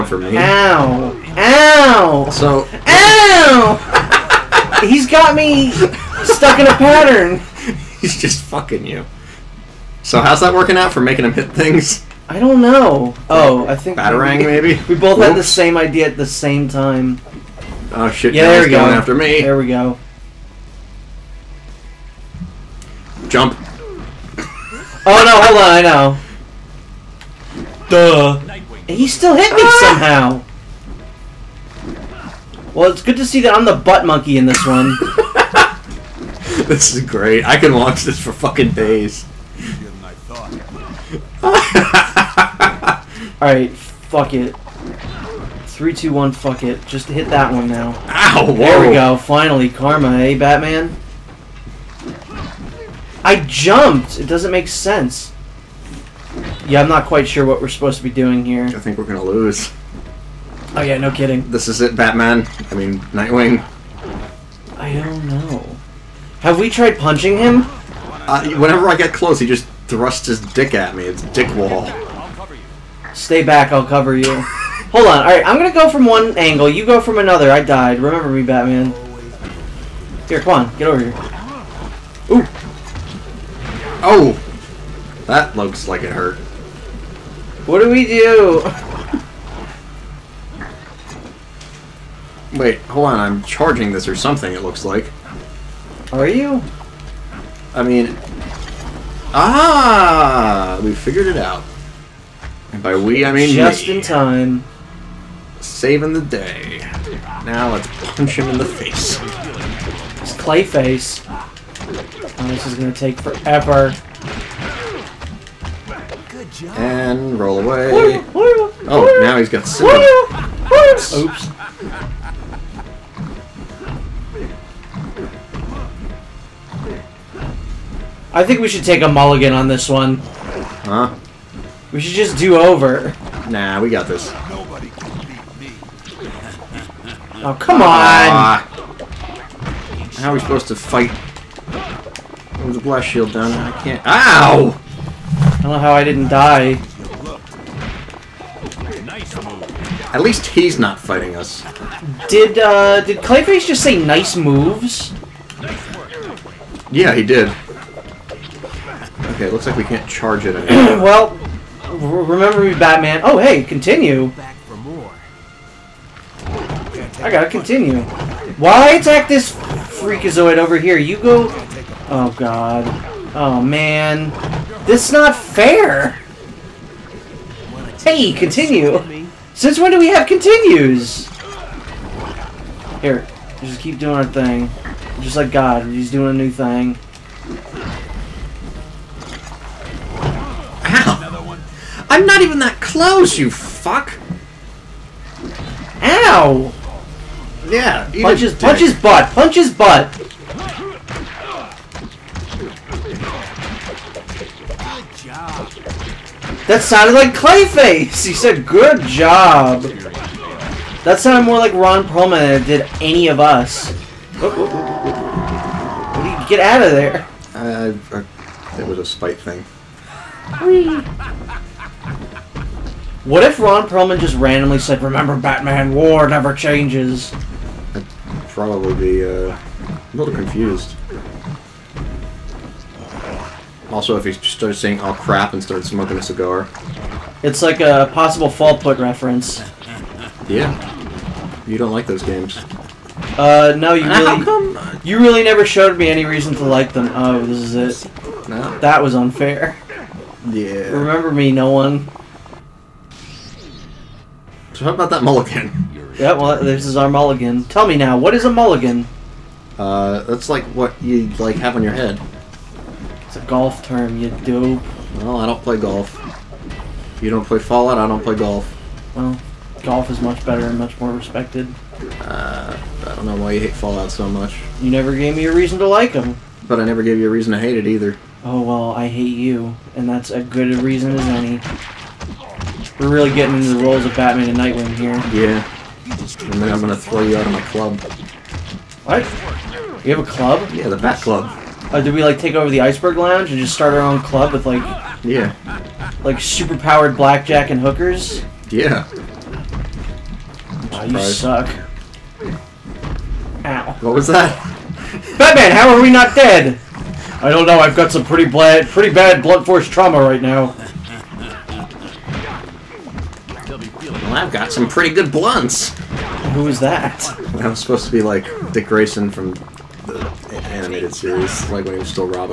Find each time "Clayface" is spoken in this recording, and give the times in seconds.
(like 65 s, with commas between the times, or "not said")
110 s, 153 s, 207 s.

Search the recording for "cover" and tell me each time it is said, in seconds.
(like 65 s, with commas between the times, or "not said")
73 s.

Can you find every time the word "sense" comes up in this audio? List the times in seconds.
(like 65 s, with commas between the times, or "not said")
54 s.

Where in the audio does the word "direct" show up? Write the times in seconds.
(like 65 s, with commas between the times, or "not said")
not said.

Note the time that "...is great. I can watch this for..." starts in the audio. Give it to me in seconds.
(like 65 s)
36 s.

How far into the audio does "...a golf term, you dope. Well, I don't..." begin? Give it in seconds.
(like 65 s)
263 s.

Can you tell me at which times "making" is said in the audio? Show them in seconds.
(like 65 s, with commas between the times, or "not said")
11 s.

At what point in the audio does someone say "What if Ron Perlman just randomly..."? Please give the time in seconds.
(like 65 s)
223 s.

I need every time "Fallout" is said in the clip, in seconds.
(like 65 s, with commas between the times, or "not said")
238 s, 267 s, 273 s.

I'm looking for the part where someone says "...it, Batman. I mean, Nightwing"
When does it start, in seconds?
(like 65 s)
61 s.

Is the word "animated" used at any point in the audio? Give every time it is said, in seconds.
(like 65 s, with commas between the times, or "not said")
320 s.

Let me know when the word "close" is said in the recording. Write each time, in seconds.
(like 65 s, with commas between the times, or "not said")
69 s, 192 s.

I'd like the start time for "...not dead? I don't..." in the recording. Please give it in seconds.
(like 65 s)
306 s.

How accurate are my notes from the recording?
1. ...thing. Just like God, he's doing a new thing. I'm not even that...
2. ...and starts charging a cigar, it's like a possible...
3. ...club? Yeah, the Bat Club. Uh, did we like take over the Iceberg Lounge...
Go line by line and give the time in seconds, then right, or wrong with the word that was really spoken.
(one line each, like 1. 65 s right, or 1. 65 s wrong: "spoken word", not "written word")
1. 184 s right
2. 235 s wrong: "smoking", not "charging"
3. 290 s right.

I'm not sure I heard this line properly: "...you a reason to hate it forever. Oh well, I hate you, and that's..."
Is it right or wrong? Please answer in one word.
wrong.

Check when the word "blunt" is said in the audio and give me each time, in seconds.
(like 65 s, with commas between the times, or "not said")
309 s, 315 s.